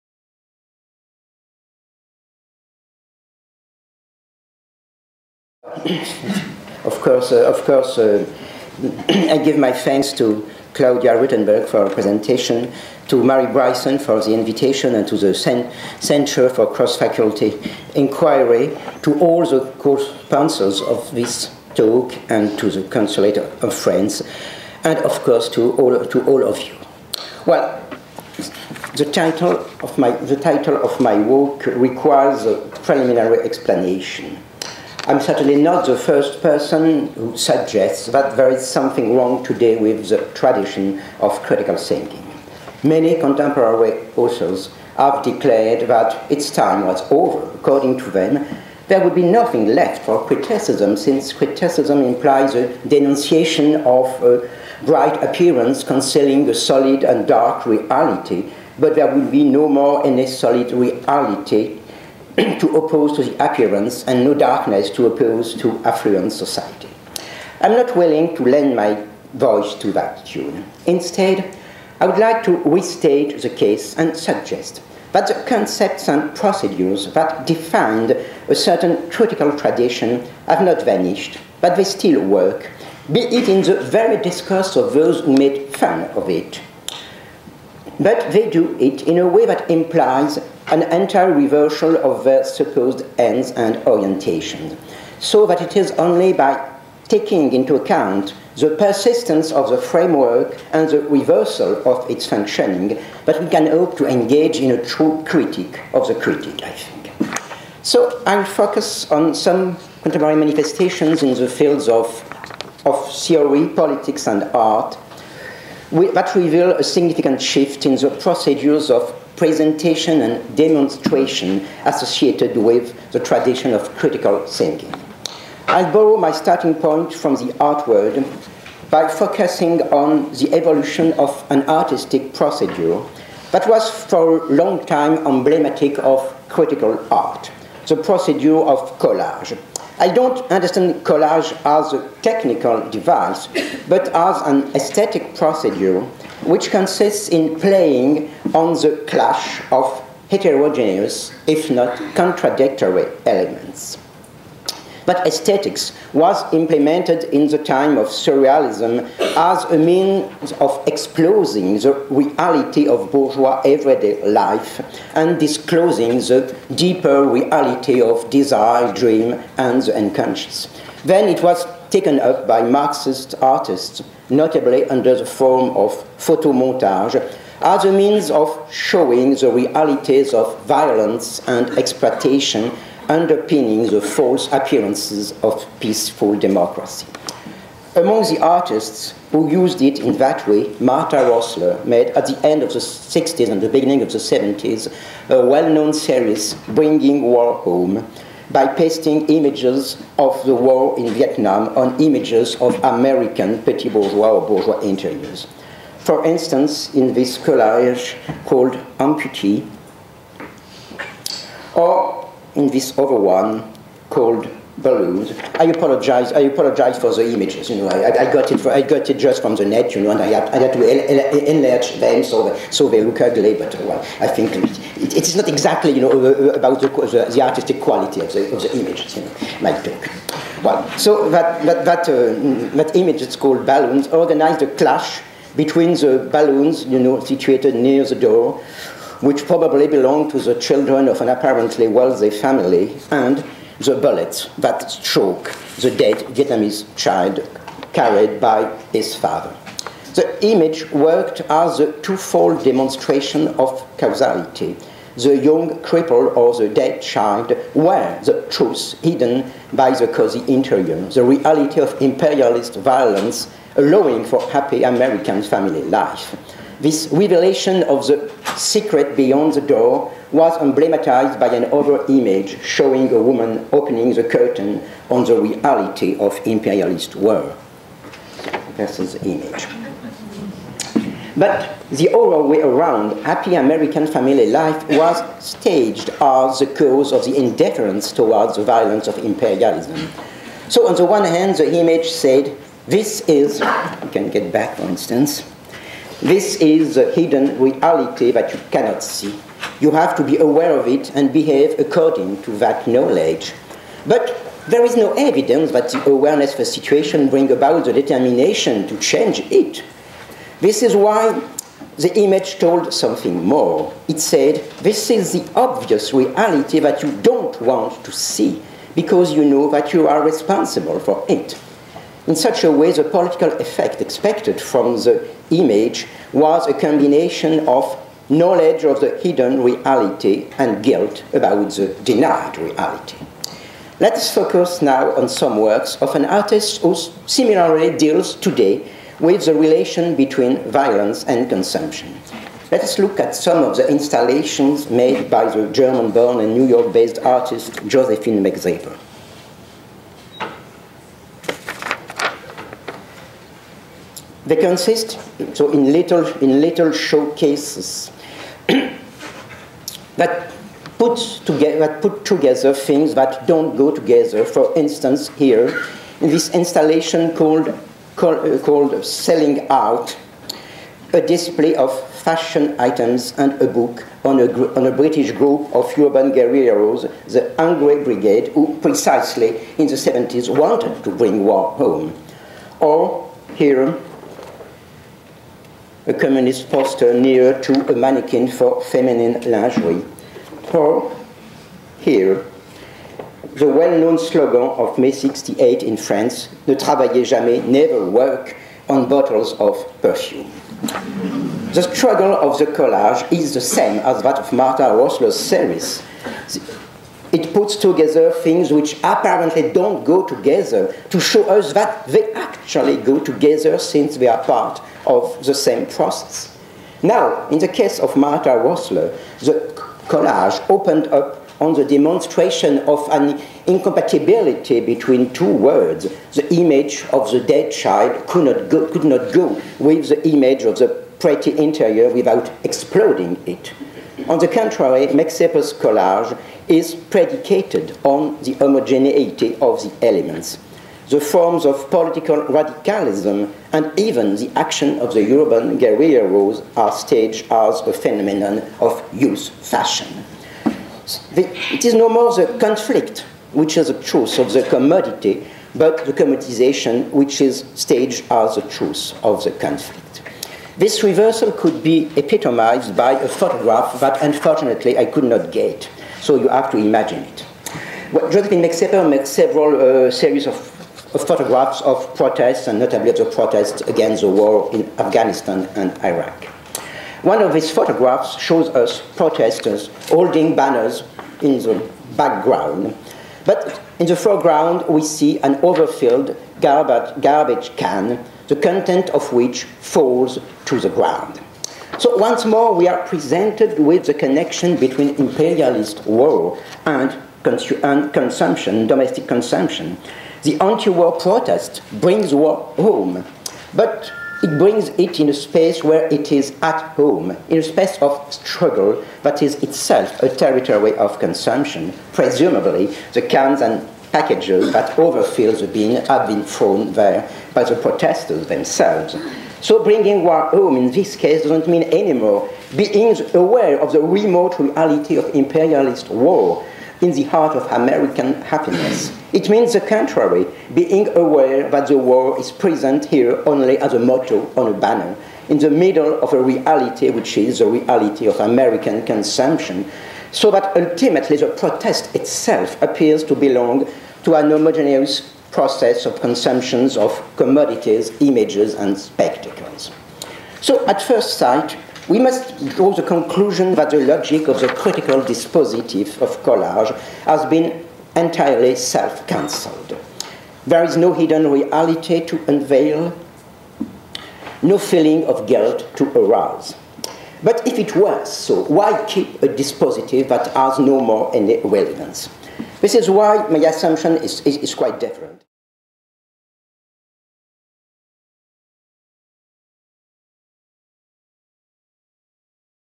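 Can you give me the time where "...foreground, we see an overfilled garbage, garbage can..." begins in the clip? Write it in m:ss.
8:04.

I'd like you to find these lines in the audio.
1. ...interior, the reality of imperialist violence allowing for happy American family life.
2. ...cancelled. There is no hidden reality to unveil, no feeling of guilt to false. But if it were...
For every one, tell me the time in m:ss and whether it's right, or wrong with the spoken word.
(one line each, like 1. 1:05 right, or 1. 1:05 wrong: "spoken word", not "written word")
1. 4:20 right
2. 9:19 wrong: "arouse", not "false".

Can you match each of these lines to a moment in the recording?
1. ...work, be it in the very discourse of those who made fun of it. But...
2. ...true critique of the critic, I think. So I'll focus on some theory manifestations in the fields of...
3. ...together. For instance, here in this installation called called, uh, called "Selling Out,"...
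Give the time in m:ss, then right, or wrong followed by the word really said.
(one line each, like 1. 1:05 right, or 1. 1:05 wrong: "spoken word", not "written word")
1. 1:22 right
2. 1:44 wrong: "contemporary", not "theory"
3. 6:03 right.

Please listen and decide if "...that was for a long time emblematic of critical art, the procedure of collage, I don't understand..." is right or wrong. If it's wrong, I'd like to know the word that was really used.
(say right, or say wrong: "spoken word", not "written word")
right.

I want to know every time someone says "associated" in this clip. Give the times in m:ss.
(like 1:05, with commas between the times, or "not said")
2:01.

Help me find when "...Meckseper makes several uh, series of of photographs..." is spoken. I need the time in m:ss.
7:48.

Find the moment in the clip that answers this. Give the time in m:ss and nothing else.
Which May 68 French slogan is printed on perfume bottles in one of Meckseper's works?
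6:36.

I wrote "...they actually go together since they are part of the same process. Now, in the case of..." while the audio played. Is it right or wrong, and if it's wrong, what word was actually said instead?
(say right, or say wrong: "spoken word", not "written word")
right.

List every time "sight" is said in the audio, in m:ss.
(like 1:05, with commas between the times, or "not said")
9:11.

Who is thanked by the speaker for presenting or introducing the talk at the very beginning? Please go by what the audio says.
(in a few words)
Claudia Ruitenberg.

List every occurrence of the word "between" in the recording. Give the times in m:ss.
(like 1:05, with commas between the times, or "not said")
3:55, 5:40, 7:04, 8:14.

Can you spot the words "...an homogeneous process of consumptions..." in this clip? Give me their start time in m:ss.
9:04.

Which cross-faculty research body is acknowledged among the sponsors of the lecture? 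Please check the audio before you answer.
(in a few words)
Centre for Cross-Faculty Inquiry.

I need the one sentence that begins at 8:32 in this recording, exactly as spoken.
Presumably, the cans and packages that overfill the bin have been thrown there by the protesters themselves.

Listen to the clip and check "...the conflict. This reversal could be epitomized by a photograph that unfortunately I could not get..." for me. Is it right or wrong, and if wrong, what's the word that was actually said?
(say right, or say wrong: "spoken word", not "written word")
right.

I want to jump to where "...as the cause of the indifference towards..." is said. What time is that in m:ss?
4:46.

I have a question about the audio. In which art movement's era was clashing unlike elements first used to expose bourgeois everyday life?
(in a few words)
Surrealism.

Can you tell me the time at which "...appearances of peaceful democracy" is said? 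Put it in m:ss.
3:04.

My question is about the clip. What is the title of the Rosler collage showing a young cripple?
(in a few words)
Amputee.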